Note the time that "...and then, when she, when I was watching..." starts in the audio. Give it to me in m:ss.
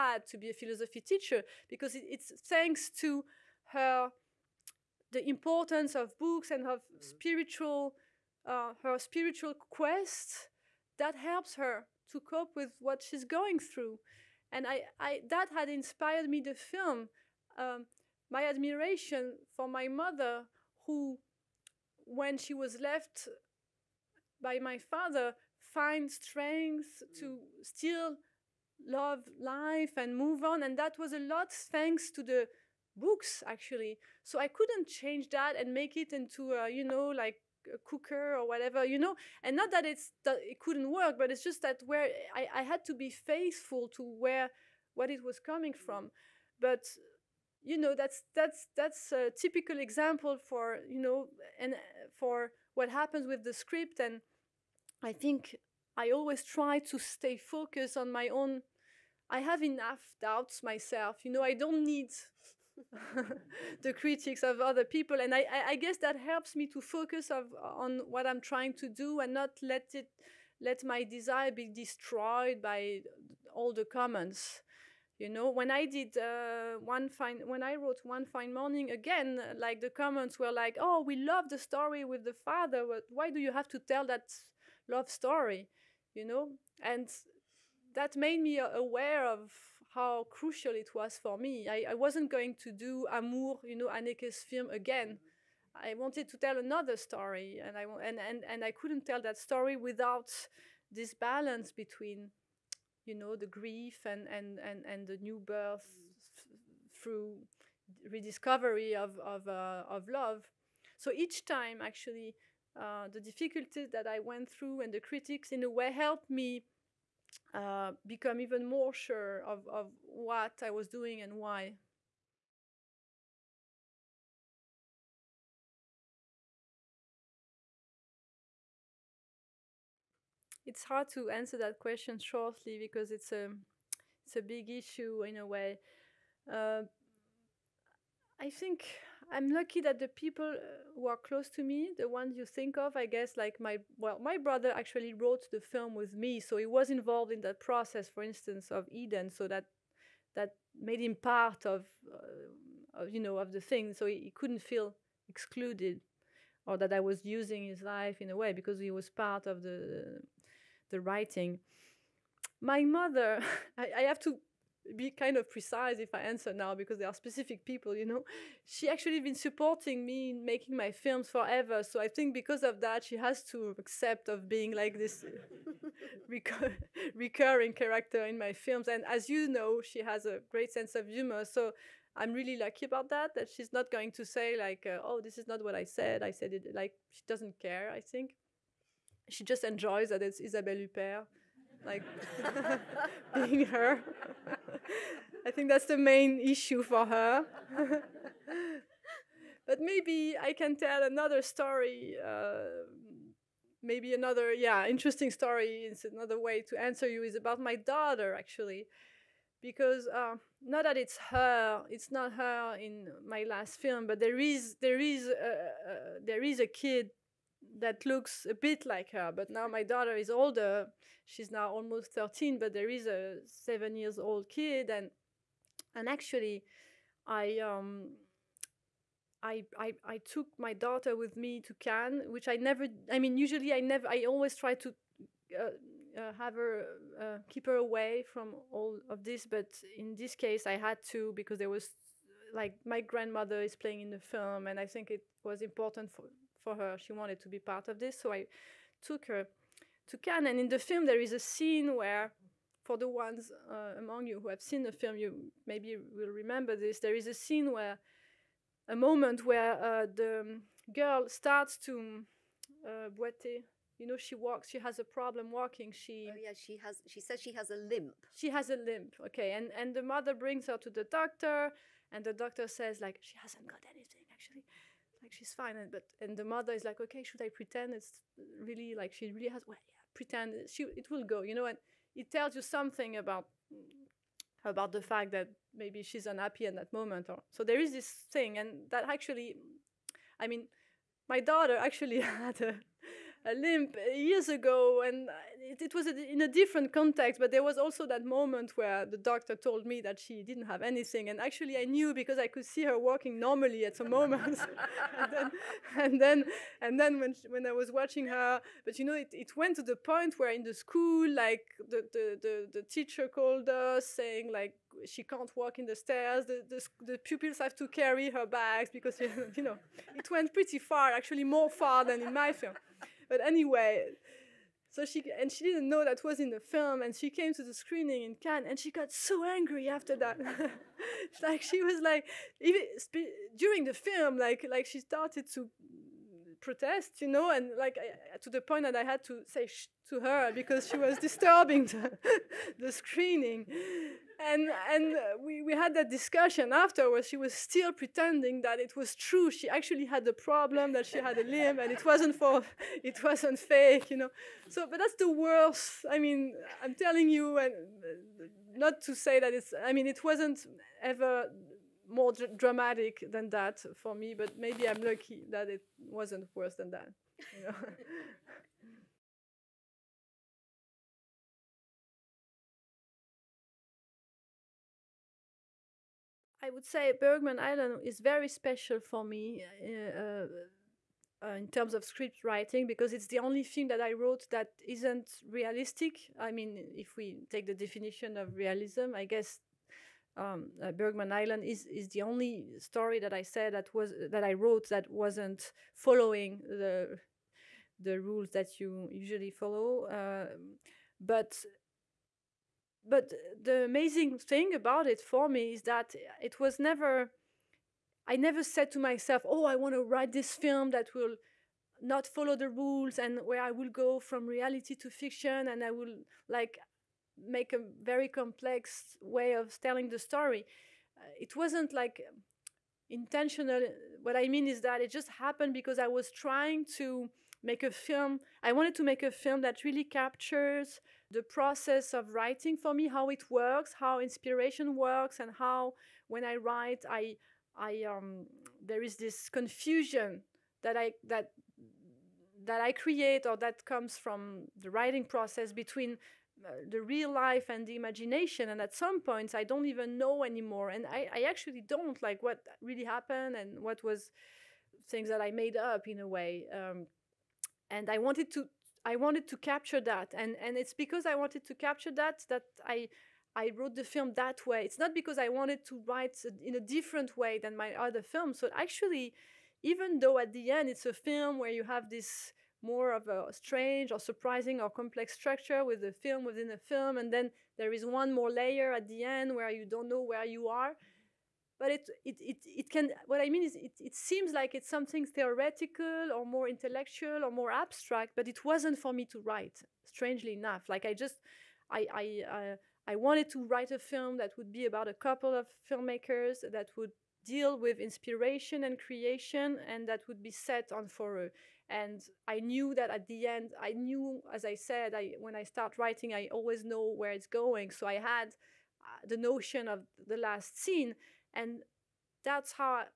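5:06.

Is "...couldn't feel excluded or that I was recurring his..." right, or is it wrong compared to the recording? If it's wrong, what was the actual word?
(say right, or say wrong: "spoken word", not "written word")
wrong: "using", not "recurring".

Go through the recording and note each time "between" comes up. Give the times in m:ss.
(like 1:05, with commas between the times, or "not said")
1:41, 7:25.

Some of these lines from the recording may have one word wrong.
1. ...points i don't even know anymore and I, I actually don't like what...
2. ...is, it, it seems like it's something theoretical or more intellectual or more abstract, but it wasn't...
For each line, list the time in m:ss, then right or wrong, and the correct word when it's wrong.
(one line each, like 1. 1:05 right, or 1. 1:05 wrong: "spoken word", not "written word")
1. 7:29 right
2. 8:03 right.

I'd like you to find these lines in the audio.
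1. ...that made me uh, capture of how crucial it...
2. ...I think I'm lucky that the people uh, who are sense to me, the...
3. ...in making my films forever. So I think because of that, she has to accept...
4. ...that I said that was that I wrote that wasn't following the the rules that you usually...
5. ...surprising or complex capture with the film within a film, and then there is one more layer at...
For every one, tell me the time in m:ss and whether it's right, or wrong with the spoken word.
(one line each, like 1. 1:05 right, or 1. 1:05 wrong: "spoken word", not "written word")
1. 1:27 wrong: "aware", not "capture"
2. 2:18 wrong: "close", not "sense"
3. 2:50 right
4. 6:33 right
5. 7:54 wrong: "structure", not "capture".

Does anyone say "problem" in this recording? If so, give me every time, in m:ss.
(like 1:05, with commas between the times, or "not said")
4:25, 5:50.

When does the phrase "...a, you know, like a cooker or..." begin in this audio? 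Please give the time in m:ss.
0:36.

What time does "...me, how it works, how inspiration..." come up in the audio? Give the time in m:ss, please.
7:12.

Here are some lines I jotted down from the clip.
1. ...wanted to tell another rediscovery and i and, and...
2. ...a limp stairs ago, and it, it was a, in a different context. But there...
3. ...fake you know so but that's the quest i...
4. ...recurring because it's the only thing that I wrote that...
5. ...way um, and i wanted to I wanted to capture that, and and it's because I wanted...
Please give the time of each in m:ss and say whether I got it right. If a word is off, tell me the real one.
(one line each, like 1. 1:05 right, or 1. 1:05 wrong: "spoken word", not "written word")
1. 1:35 wrong: "story", not "rediscovery"
2. 4:53 wrong: "years", not "stairs"
3. 5:53 wrong: "worst", not "quest"
4. 6:22 wrong: "writing", not "recurring"
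5. 7:36 right.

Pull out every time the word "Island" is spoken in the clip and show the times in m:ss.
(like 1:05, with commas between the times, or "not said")
6:17, 6:31.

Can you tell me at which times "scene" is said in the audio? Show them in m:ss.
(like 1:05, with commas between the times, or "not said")
4:11, 4:17, 8:30.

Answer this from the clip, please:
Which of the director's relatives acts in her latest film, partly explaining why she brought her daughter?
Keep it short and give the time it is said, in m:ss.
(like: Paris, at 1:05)
Grandmother, at 4:03.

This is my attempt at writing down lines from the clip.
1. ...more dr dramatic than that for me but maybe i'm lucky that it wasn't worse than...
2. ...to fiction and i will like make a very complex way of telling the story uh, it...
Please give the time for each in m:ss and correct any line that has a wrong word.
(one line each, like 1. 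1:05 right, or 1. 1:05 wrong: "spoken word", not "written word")
1. 6:02 right
2. 6:54 right.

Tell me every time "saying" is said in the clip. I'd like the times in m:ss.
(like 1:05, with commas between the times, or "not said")
5:14.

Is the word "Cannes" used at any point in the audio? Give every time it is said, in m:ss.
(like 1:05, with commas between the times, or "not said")
3:51, 4:10, 5:28.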